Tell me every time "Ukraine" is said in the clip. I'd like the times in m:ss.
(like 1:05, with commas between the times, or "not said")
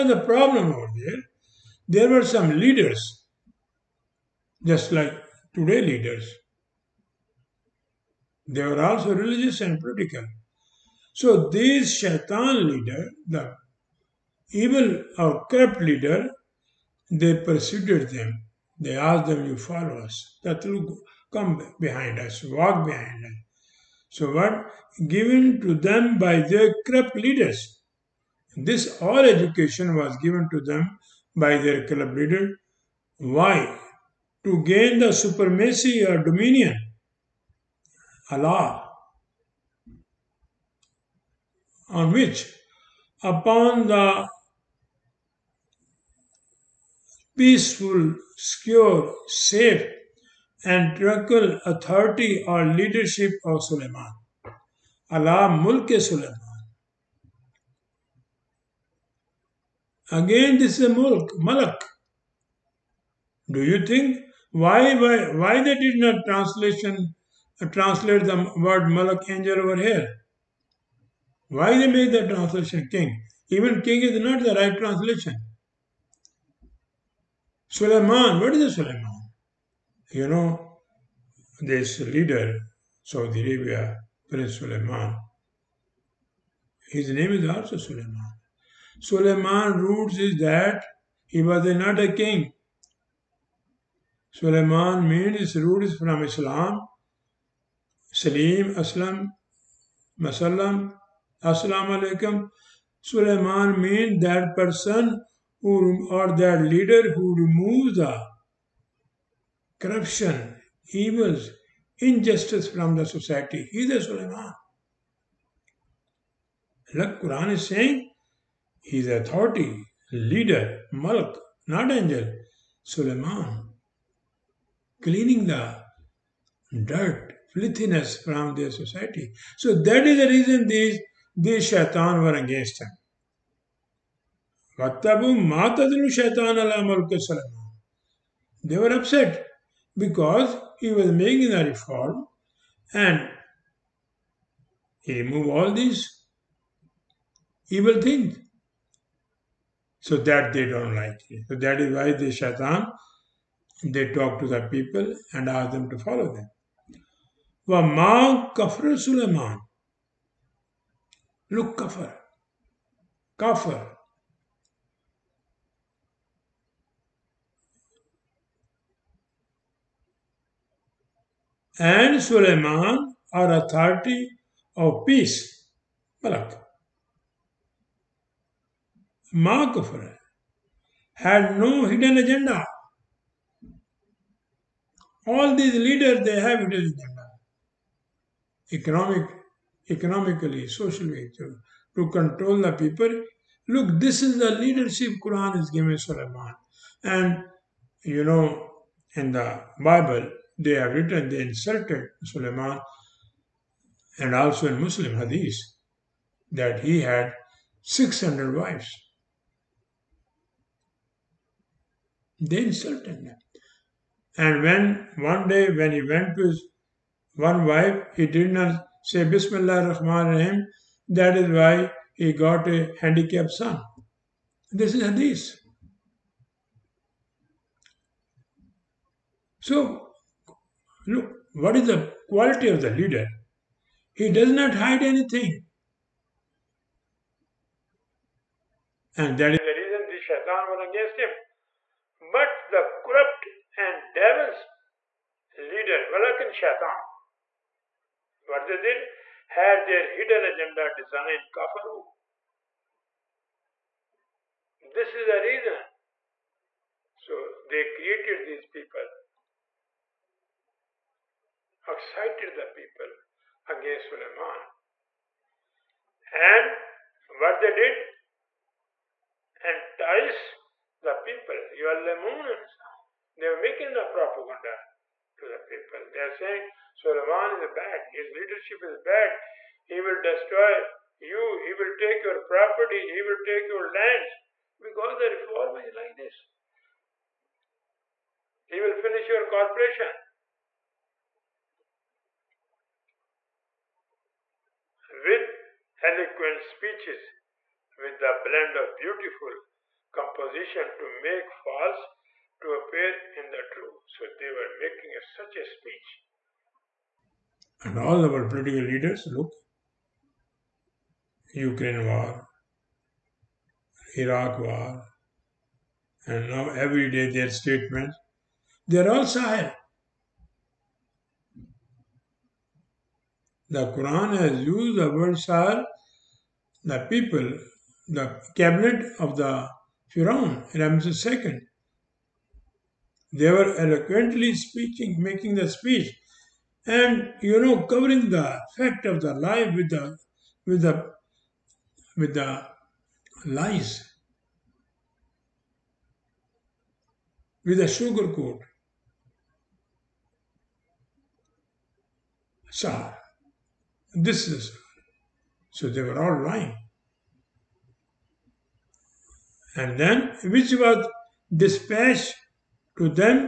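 5:11.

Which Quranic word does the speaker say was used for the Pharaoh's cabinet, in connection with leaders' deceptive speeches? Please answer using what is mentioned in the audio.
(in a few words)
Sahar.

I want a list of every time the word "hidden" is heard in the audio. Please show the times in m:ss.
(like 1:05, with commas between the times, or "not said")
3:01, 3:06, 4:10.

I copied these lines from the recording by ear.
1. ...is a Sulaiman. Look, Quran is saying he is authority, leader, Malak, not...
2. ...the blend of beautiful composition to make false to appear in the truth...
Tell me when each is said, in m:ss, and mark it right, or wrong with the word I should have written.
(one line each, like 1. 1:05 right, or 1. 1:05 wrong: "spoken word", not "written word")
1. 1:53 right
2. 4:58 right.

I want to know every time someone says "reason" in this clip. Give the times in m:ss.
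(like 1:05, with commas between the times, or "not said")
2:10, 3:59, 4:15.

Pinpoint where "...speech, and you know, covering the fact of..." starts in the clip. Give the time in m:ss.
5:35.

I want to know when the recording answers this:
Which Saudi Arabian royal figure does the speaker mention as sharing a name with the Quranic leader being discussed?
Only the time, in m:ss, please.
1:24.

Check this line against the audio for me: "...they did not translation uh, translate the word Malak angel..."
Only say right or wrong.
right.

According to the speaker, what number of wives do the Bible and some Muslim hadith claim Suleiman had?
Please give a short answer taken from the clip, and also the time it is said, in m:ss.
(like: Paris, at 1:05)
600, at 3:27.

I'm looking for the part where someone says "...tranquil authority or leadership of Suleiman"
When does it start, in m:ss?
0:50.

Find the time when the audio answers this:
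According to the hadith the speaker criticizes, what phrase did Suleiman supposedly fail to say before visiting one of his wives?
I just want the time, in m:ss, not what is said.
3:39.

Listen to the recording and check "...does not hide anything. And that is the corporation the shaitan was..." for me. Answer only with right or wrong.
wrong.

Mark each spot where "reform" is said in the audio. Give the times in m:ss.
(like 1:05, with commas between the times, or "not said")
2:21, 4:45.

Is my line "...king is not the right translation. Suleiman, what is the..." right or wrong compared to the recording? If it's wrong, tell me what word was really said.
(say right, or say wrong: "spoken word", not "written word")
right.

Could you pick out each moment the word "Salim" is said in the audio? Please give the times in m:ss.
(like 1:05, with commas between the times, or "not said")
1:38.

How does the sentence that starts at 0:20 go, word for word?
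That will come behind us, walk behind us.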